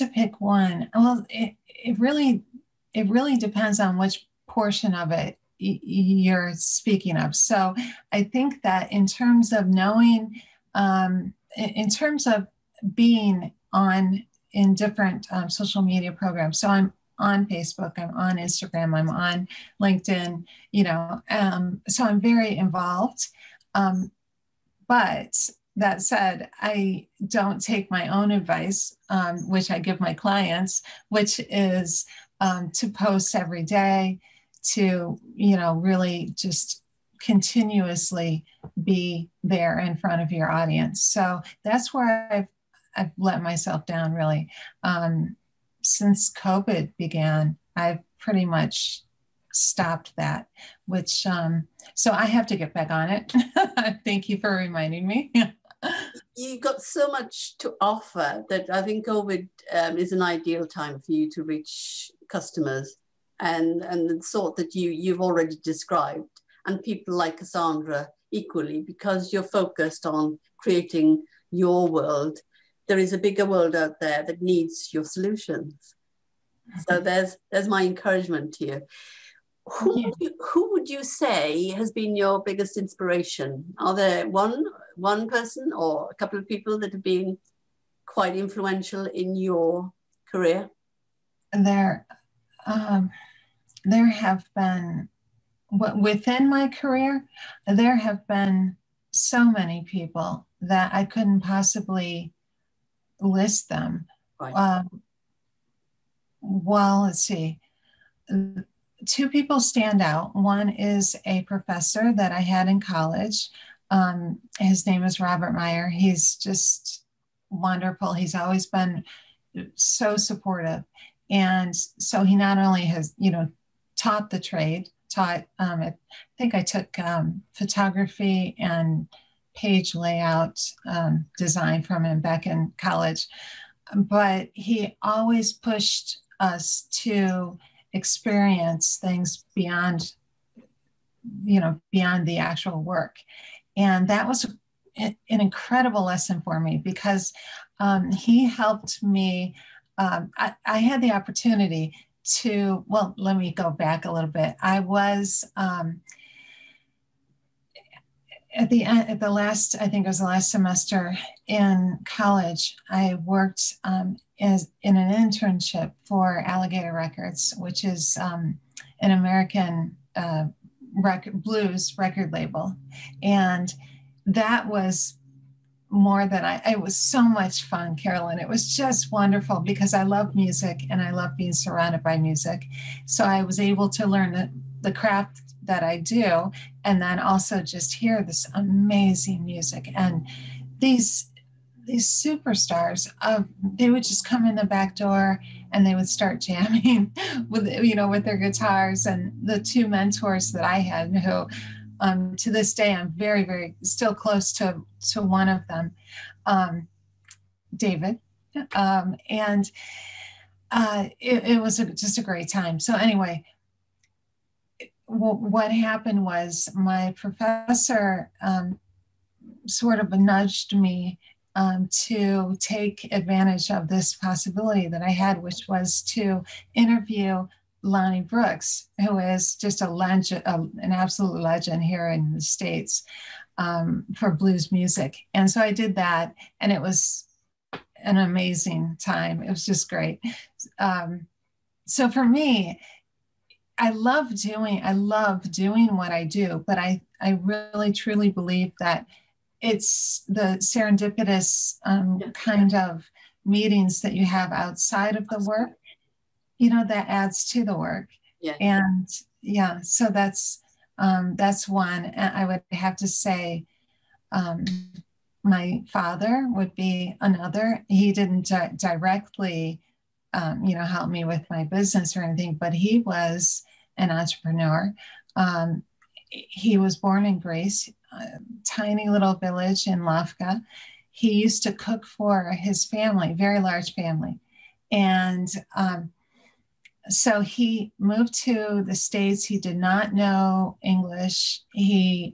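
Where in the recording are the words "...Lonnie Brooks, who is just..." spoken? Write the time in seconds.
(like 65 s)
227 s.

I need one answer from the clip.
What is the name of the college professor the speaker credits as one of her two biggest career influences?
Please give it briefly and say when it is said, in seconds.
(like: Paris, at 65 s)
Robert Meyer, at 115 s.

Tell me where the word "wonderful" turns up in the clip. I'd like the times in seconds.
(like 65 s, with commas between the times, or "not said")
117 s, 179 s.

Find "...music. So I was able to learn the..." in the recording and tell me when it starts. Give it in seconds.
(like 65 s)
182 s.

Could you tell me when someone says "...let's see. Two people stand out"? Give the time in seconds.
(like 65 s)
107 s.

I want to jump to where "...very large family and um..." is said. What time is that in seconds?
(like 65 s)
283 s.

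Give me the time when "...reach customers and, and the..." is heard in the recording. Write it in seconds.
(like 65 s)
61 s.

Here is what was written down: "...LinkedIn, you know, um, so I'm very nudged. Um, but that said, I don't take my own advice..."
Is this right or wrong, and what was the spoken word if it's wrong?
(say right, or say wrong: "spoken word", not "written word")
wrong: "involved", not "nudged".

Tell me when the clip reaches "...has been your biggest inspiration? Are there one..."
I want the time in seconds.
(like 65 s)
81 s.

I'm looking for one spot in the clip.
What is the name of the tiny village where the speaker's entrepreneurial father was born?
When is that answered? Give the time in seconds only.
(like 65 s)
280 s.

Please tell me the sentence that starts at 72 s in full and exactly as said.
There is a bigger world out there that needs your solutions.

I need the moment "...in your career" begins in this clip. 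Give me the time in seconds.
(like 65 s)
89 s.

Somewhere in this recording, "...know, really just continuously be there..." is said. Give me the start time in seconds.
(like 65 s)
35 s.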